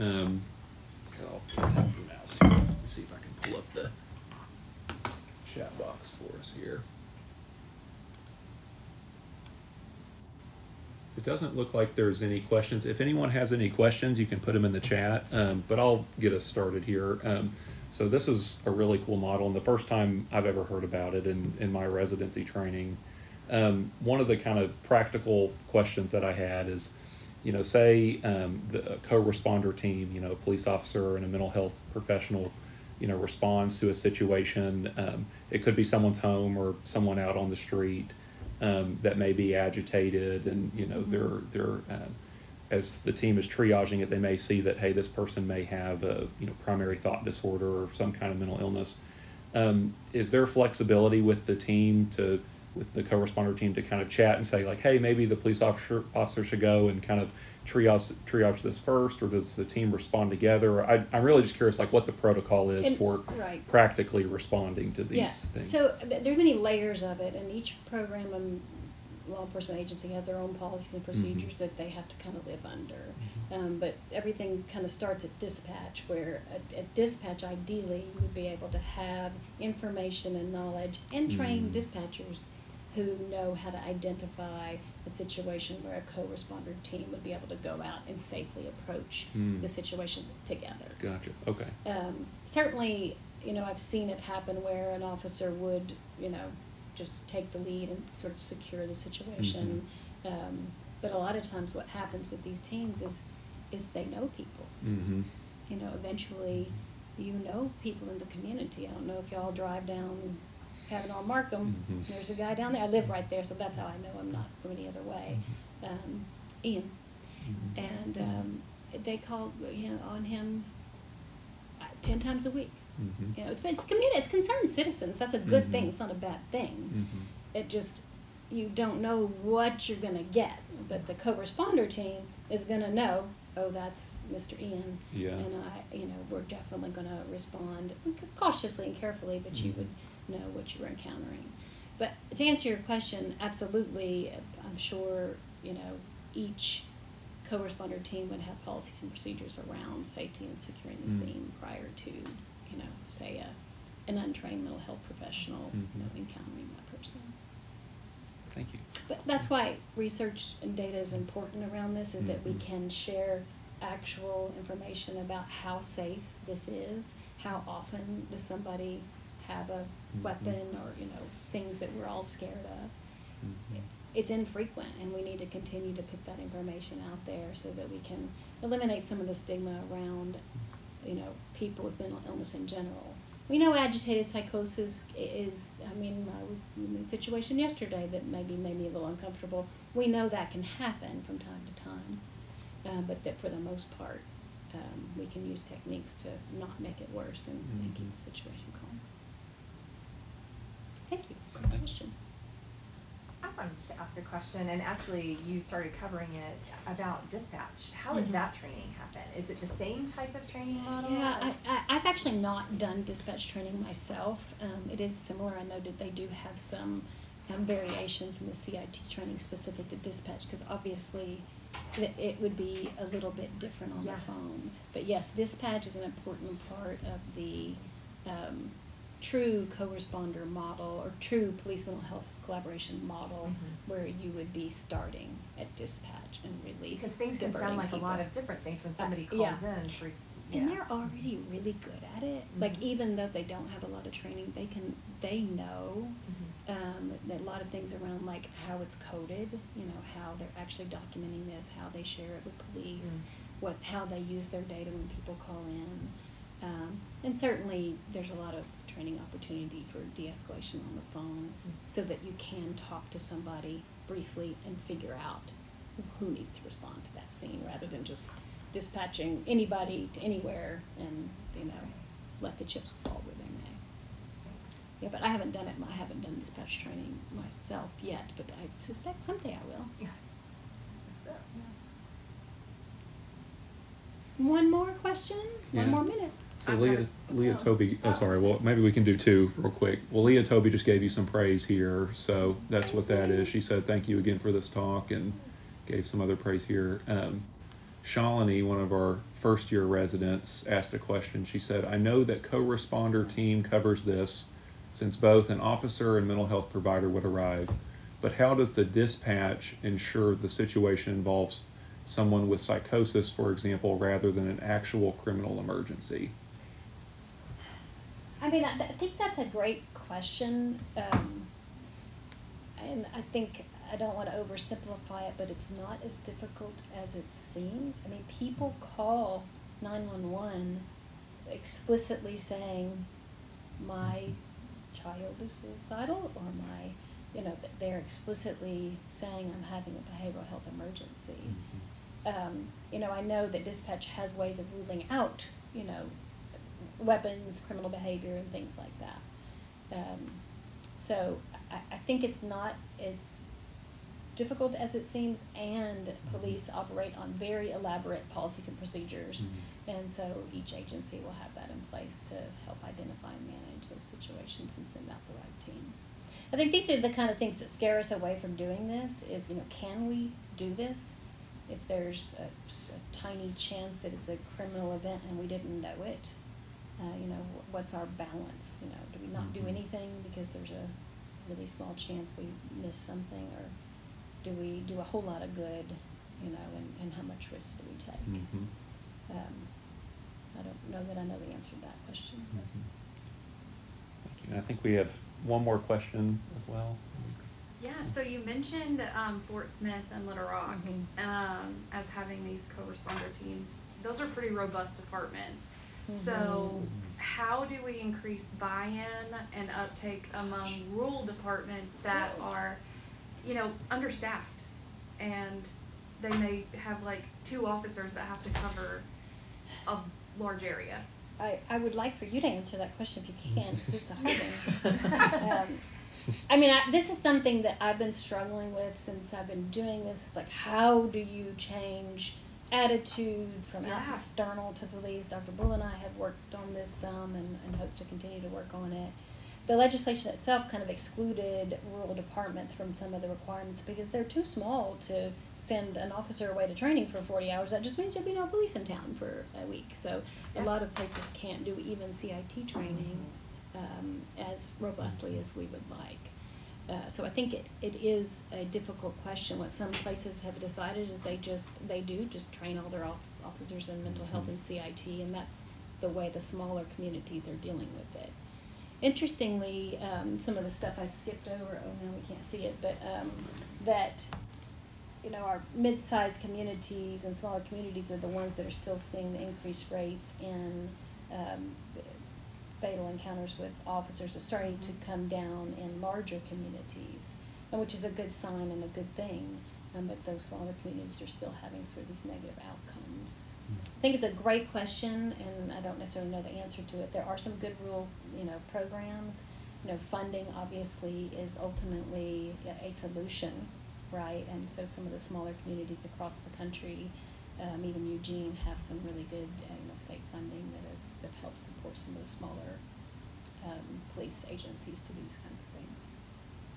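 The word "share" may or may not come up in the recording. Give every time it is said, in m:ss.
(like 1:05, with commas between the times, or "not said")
2:42, 4:12.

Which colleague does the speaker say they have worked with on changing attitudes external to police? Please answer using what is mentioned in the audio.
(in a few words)
Dr. Bull.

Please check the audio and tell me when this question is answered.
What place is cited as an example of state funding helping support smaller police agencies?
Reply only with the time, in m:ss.
8:28.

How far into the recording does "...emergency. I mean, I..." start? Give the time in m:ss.
5:15.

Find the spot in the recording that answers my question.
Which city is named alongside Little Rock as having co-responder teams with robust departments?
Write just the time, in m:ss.
6:39.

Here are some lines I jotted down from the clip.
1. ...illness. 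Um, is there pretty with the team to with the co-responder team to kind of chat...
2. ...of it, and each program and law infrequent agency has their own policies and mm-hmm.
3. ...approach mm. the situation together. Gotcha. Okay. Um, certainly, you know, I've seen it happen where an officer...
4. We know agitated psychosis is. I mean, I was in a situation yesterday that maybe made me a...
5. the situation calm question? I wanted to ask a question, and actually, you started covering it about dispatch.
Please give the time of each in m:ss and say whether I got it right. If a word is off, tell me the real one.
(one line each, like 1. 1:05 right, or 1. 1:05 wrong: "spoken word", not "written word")
1. 0:48 wrong: "flexibility", not "pretty"
2. 1:07 wrong: "enforcement", not "infrequent"
3. 1:28 right
4. 3:03 right
5. 3:18 right.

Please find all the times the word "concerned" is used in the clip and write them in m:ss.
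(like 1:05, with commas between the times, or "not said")
2:04.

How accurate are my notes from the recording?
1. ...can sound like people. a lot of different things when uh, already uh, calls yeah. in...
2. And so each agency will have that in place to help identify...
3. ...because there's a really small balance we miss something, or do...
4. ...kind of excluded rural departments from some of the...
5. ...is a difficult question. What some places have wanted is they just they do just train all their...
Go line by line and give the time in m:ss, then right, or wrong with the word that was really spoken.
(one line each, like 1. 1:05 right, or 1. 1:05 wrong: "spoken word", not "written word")
1. 3:57 wrong: "somebody", not "already"
2. 6:00 right
3. 6:20 wrong: "chance", not "balance"
4. 7:20 right
5. 7:38 wrong: "decided", not "wanted".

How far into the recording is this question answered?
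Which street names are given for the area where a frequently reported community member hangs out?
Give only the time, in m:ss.
1:50.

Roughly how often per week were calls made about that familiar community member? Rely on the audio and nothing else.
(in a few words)
10 times a week.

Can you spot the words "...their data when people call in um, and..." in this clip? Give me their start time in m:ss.
4:14.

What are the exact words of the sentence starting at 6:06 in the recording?
I think these are the kind of things that scare us away from doing this is, you know, can we do this?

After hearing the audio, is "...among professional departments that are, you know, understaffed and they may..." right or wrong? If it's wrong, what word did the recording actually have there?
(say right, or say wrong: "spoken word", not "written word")
wrong: "rural", not "professional".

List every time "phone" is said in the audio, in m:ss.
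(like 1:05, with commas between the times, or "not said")
3:44, 4:21.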